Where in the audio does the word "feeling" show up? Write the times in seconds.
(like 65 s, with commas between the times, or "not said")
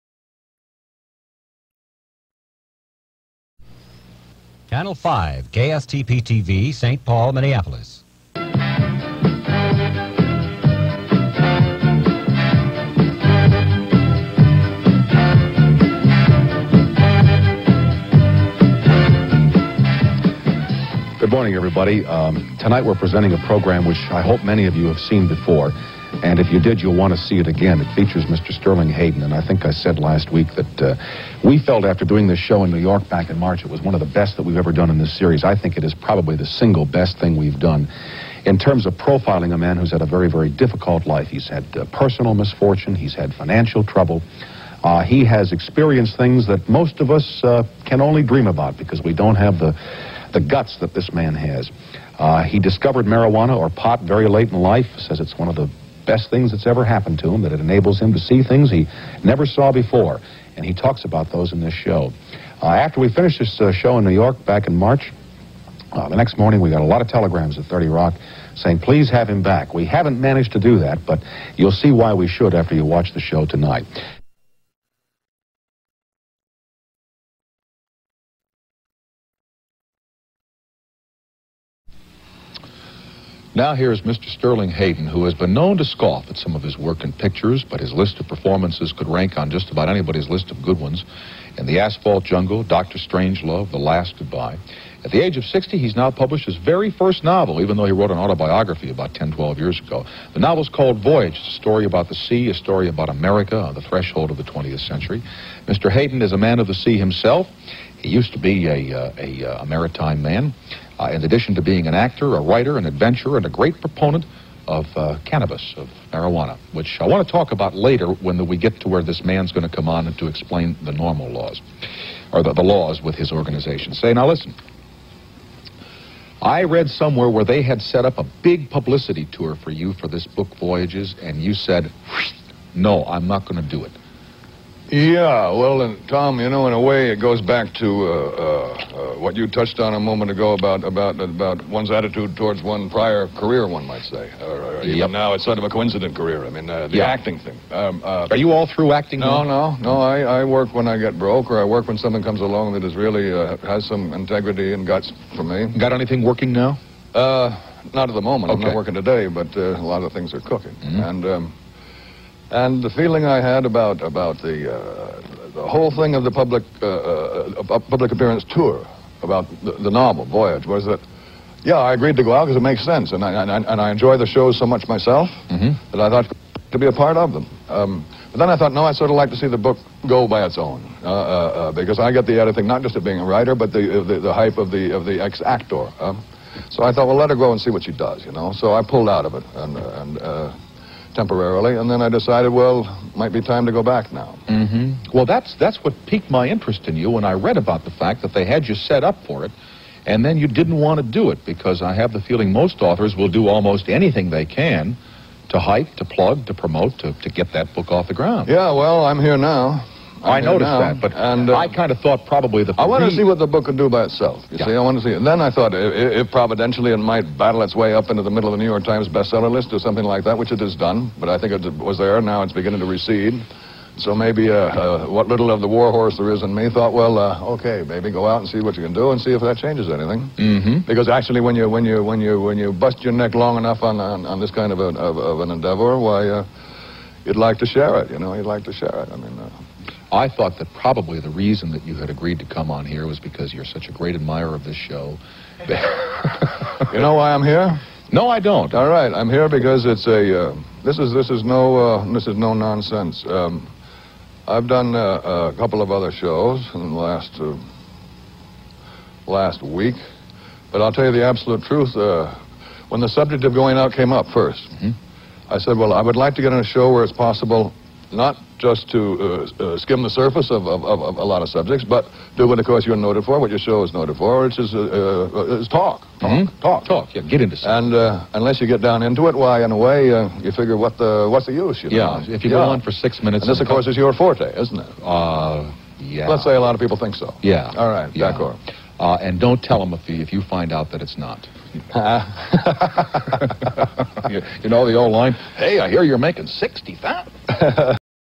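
162 s, 202 s.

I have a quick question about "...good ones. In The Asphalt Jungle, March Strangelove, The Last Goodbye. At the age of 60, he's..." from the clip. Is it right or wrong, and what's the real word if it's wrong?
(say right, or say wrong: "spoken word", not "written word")
wrong: "Doctor", not "March".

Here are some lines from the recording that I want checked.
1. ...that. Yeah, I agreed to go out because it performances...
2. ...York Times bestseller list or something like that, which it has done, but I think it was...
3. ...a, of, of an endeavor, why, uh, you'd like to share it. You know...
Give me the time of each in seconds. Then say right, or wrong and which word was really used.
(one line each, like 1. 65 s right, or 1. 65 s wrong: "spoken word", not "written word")
1. 170 s wrong: "makes", not "performances"
2. 218 s right
3. 234 s right.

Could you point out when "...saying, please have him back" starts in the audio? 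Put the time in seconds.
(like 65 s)
68 s.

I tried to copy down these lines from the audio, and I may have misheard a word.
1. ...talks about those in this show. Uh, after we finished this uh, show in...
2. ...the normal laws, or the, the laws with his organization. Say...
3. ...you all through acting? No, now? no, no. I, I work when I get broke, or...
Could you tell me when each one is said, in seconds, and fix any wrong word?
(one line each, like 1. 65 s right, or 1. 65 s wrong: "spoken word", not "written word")
1. 60 s right
2. 120 s right
3. 148 s right.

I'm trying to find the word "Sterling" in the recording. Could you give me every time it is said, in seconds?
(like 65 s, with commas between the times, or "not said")
28 s, 84 s.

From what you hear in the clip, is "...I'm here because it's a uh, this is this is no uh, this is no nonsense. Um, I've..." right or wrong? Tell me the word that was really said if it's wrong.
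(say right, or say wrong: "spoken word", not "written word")
right.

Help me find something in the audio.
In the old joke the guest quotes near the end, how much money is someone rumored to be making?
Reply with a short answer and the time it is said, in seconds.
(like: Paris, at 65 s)
60,000, at 296 s.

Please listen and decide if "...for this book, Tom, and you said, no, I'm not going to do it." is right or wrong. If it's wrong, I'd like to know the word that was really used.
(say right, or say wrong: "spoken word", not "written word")
wrong: "Voyages", not "Tom".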